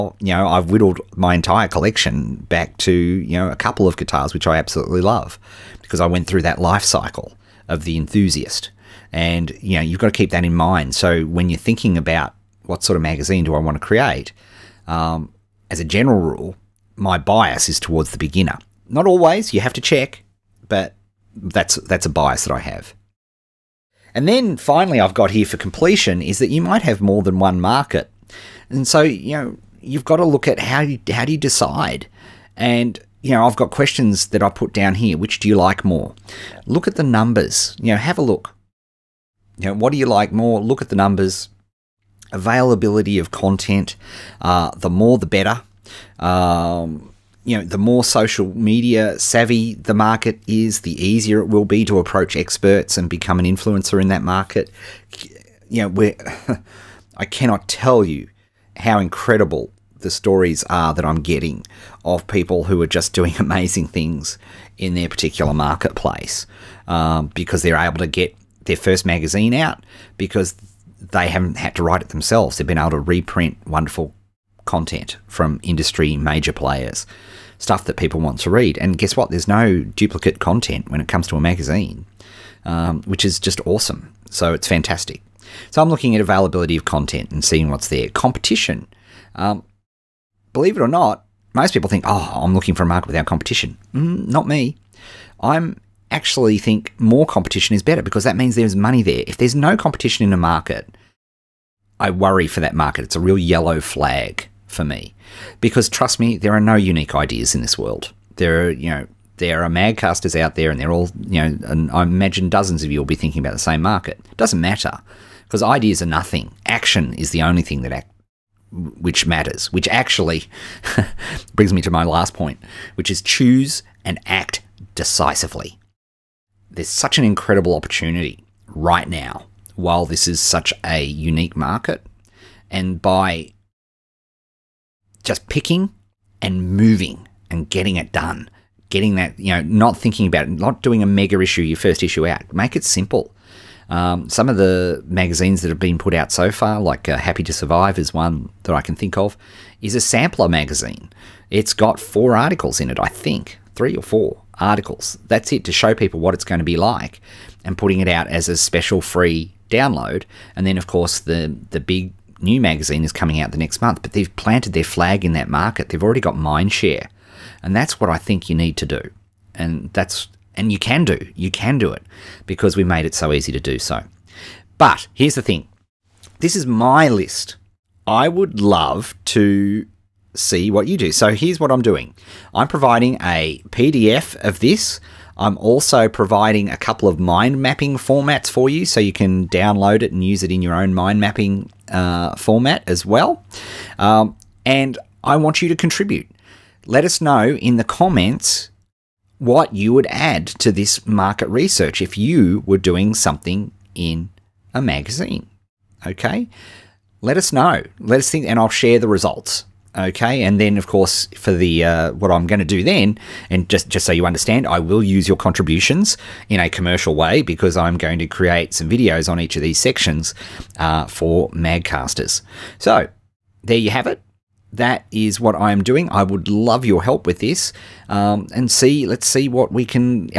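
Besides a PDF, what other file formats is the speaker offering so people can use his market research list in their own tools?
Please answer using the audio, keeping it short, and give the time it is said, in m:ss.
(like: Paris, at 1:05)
Mind mapping formats, at 3:07.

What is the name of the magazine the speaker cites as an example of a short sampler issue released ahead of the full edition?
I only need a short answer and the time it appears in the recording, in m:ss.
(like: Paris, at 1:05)
Happy to Survive, at 2:27.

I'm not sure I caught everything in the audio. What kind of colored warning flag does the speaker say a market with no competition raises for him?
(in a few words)
Yellow flag.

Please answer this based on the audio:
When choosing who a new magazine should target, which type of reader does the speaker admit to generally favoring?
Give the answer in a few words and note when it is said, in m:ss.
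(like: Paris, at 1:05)
The beginner, at 0:18.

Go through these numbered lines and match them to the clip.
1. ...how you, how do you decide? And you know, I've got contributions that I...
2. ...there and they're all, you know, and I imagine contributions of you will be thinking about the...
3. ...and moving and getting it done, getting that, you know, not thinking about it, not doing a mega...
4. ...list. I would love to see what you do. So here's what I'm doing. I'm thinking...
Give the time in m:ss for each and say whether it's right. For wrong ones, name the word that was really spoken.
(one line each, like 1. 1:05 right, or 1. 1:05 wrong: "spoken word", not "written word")
1. 0:30 wrong: "questions", not "contributions"
2. 1:50 wrong: "dozens", not "contributions"
3. 2:16 right
4. 2:57 wrong: "providing", not "thinking".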